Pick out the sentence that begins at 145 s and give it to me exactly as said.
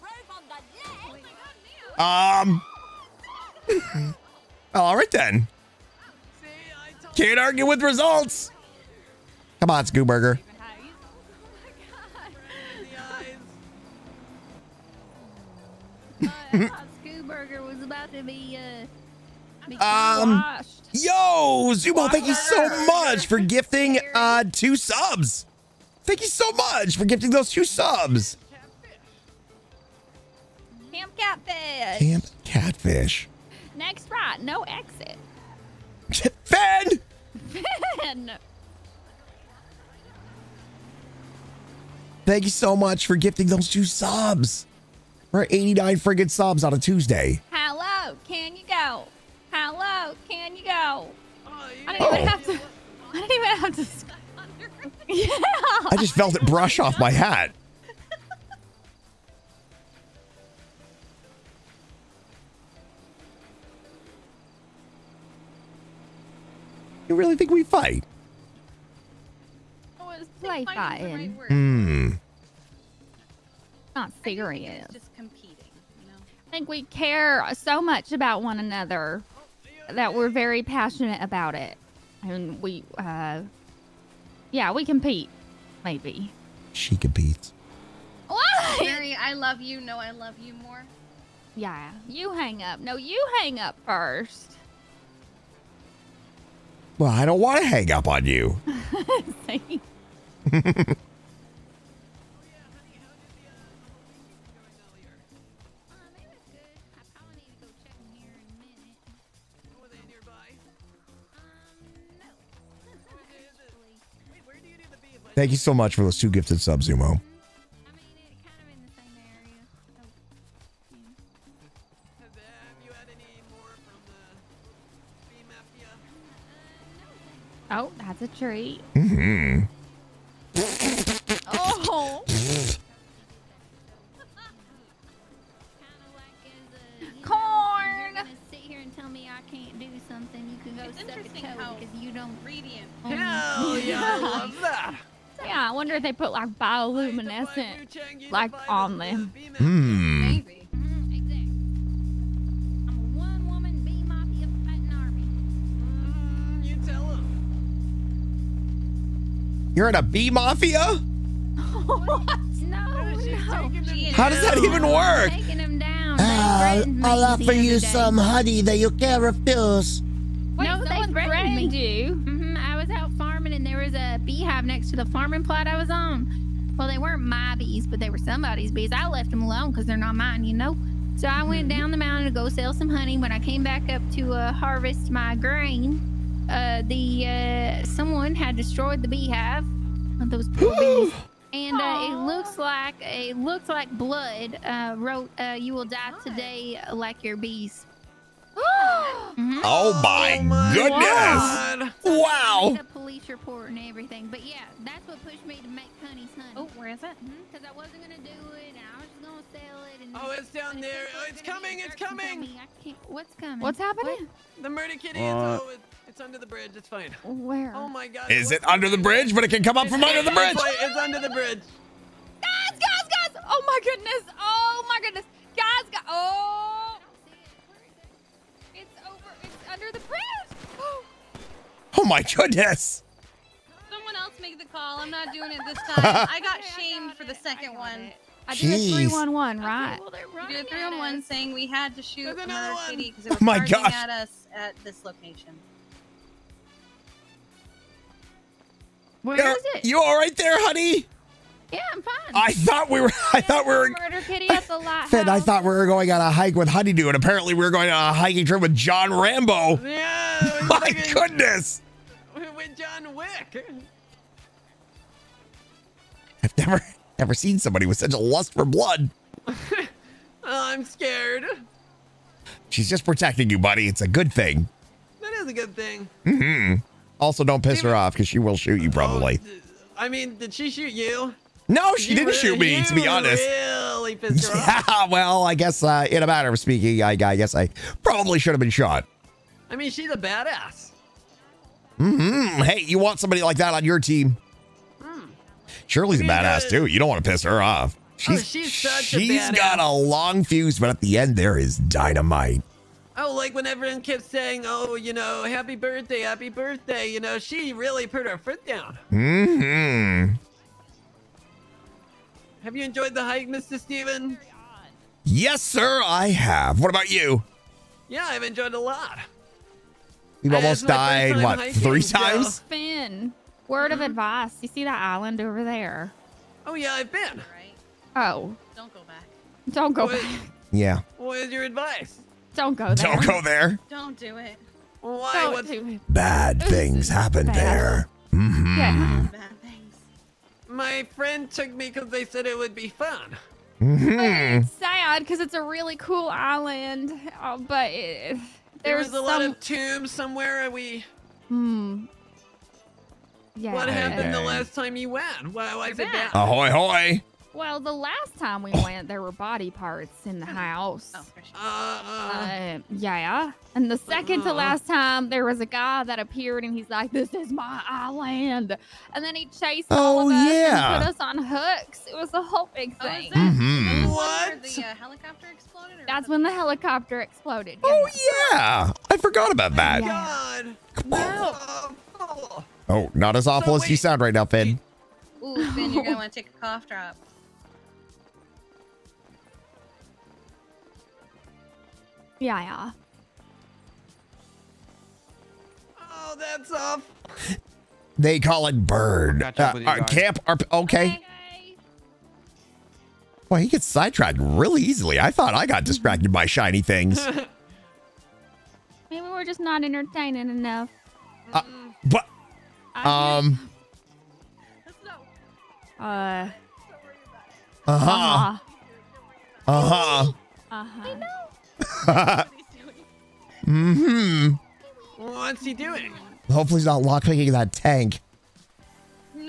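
Yeah, I wonder if they put like bioluminescent like on them.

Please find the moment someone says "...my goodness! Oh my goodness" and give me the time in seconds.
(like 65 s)
223 s.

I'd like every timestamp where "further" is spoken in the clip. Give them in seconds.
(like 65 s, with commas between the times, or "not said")
not said.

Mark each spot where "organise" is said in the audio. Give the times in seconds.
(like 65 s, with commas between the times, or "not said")
not said.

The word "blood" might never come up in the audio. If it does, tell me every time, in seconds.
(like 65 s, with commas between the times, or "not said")
194 s, 268 s.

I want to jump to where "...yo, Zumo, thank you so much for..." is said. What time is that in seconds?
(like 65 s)
20 s.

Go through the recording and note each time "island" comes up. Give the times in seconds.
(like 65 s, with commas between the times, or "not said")
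325 s, 346 s, 367 s.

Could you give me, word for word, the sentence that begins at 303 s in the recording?
Oh, like when everyone kept saying, oh, you know, happy birthday, happy birthday.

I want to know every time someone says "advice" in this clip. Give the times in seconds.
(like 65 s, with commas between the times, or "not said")
324 s, 331 s.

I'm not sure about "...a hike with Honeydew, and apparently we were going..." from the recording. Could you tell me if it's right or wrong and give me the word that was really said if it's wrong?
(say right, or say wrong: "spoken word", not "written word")
right.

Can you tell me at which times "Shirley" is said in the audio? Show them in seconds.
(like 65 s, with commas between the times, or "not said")
295 s.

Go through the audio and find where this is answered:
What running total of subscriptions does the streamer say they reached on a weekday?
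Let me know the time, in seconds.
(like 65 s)
45 s.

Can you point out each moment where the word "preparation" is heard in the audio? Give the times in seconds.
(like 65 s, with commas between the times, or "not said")
not said.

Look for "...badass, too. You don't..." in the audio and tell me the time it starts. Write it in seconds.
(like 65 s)
296 s.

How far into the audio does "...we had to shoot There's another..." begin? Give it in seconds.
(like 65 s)
241 s.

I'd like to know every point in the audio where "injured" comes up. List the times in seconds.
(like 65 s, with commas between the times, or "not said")
not said.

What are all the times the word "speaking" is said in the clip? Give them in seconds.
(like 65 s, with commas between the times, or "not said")
286 s.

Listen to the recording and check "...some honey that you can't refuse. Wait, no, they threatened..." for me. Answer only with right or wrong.
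right.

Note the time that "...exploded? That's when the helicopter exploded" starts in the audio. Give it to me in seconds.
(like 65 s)
375 s.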